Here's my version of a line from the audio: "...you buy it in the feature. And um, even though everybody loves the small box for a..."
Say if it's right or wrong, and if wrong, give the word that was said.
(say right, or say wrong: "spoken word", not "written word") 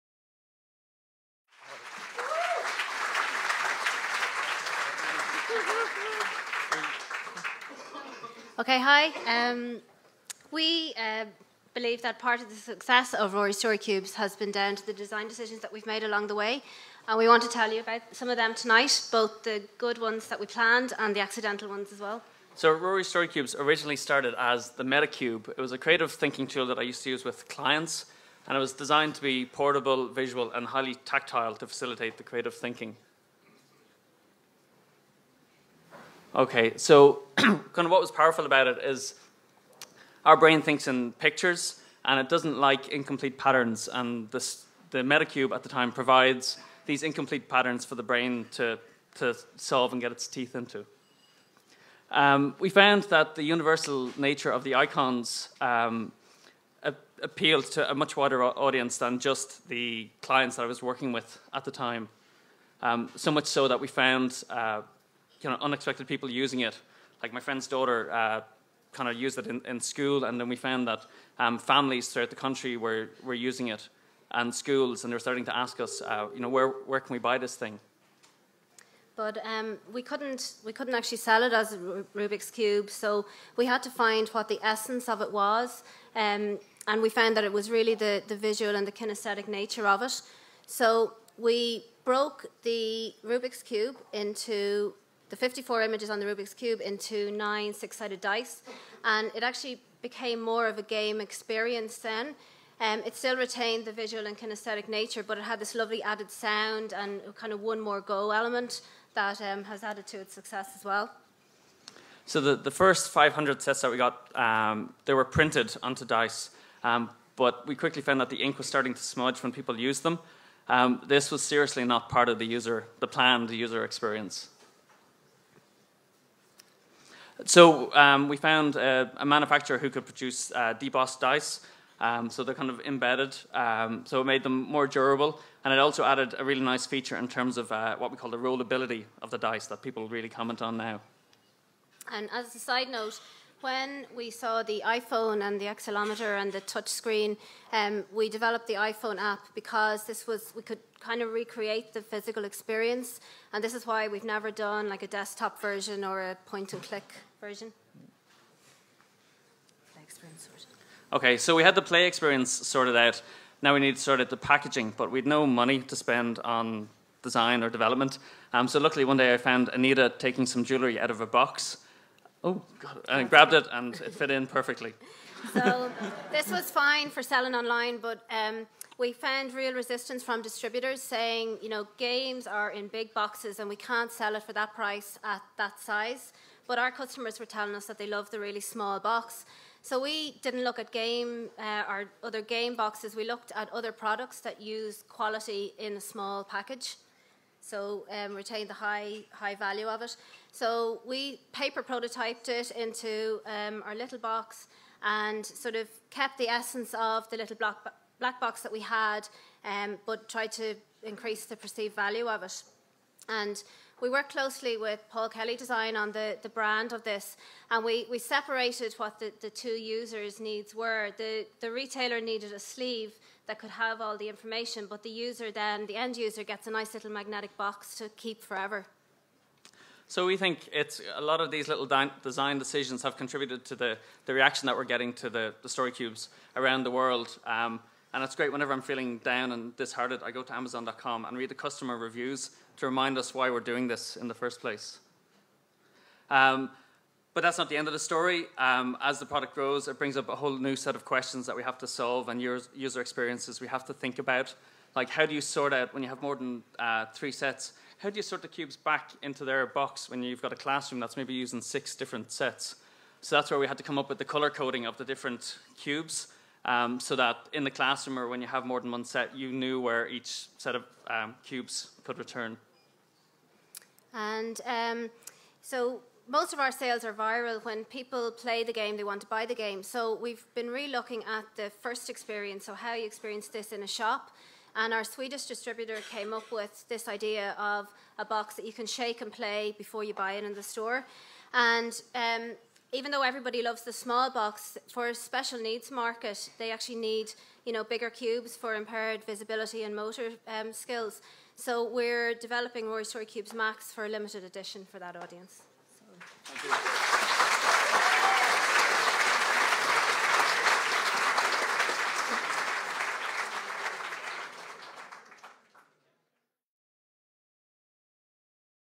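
wrong: "store", not "feature".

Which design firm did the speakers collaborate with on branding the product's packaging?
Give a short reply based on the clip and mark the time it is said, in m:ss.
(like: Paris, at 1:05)
Paul Kelly Design, at 3:35.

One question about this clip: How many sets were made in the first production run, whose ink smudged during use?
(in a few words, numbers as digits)
500.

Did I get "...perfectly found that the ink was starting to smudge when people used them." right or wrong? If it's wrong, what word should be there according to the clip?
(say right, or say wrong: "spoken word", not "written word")
wrong: "quickly", not "perfectly".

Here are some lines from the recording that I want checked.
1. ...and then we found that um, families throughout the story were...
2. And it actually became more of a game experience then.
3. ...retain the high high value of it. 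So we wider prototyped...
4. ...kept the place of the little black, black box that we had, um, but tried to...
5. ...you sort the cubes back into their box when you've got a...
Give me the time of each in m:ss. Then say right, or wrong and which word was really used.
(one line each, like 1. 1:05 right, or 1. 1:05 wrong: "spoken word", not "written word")
1. 1:10 wrong: "country", not "story"
2. 1:39 right
3. 3:18 wrong: "paper", not "wider"
4. 3:26 wrong: "essence", not "place"
5. 4:18 right.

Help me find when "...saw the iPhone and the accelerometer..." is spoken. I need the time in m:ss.
2:24.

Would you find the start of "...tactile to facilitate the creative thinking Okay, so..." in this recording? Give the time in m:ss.
0:31.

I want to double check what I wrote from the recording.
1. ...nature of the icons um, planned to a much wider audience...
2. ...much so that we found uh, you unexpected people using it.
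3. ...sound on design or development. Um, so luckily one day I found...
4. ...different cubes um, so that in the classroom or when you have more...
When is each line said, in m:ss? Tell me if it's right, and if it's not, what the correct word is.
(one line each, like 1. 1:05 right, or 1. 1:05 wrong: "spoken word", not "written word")
1. 0:54 wrong: "appealed", not "planned"
2. 1:03 right
3. 2:45 wrong: "spend", not "sound"
4. 4:25 right.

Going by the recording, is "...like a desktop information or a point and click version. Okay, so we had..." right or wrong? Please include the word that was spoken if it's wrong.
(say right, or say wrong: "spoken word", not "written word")
wrong: "version", not "information".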